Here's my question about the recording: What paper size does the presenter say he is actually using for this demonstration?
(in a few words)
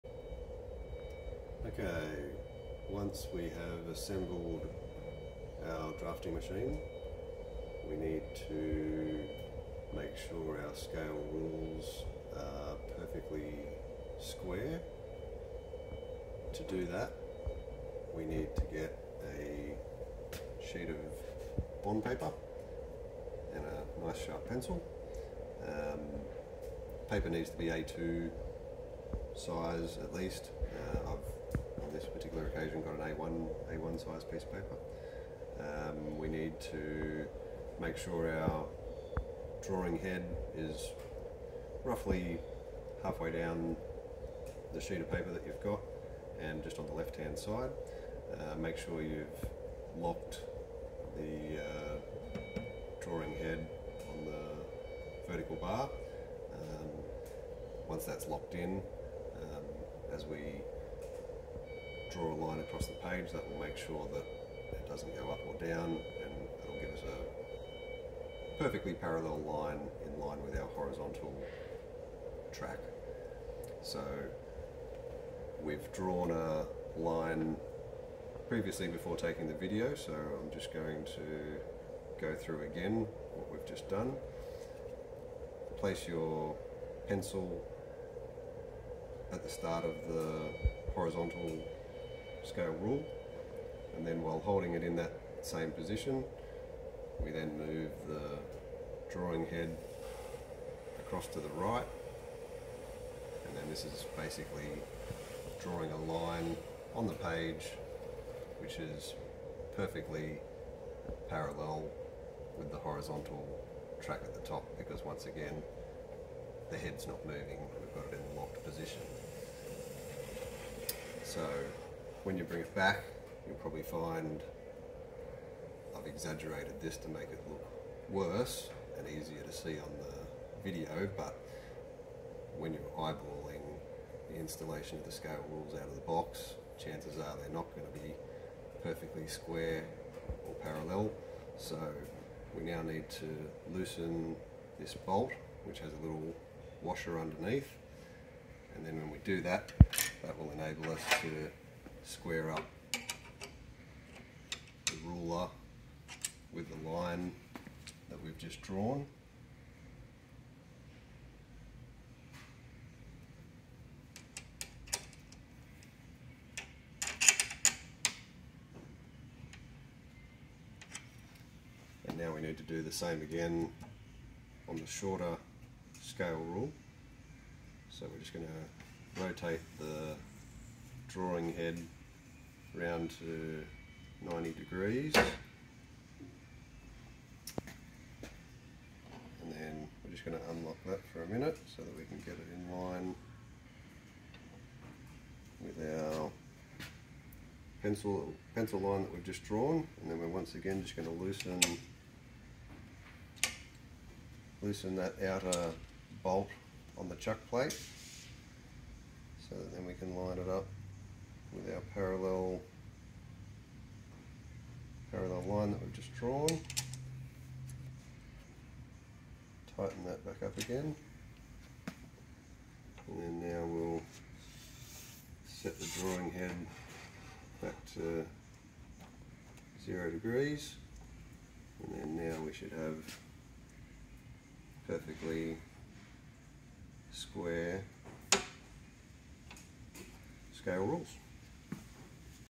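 A1.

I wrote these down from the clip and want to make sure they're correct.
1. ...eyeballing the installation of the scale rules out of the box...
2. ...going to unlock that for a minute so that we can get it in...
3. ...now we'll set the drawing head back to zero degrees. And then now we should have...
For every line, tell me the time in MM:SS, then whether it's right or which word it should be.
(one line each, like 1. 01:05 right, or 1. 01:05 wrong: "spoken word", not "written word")
1. 02:12 right
2. 03:10 right
3. 03:43 right.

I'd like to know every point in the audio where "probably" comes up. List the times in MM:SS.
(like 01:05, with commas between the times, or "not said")
02:03.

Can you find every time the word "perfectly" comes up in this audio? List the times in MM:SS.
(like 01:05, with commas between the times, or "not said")
00:12, 01:08, 01:49, 02:18, 03:54.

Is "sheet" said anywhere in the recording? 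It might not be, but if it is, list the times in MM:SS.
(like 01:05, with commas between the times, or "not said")
00:20, 00:44.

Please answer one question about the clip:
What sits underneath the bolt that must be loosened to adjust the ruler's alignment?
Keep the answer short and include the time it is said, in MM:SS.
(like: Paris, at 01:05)
A little washer, at 02:26.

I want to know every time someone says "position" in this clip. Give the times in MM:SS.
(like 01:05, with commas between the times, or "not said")
01:35, 01:58.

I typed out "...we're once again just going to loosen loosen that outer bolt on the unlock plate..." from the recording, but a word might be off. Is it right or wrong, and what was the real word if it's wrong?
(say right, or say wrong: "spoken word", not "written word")
wrong: "chuck", not "unlock".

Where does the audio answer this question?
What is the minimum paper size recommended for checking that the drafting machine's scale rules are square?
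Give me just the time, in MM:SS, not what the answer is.
00:27.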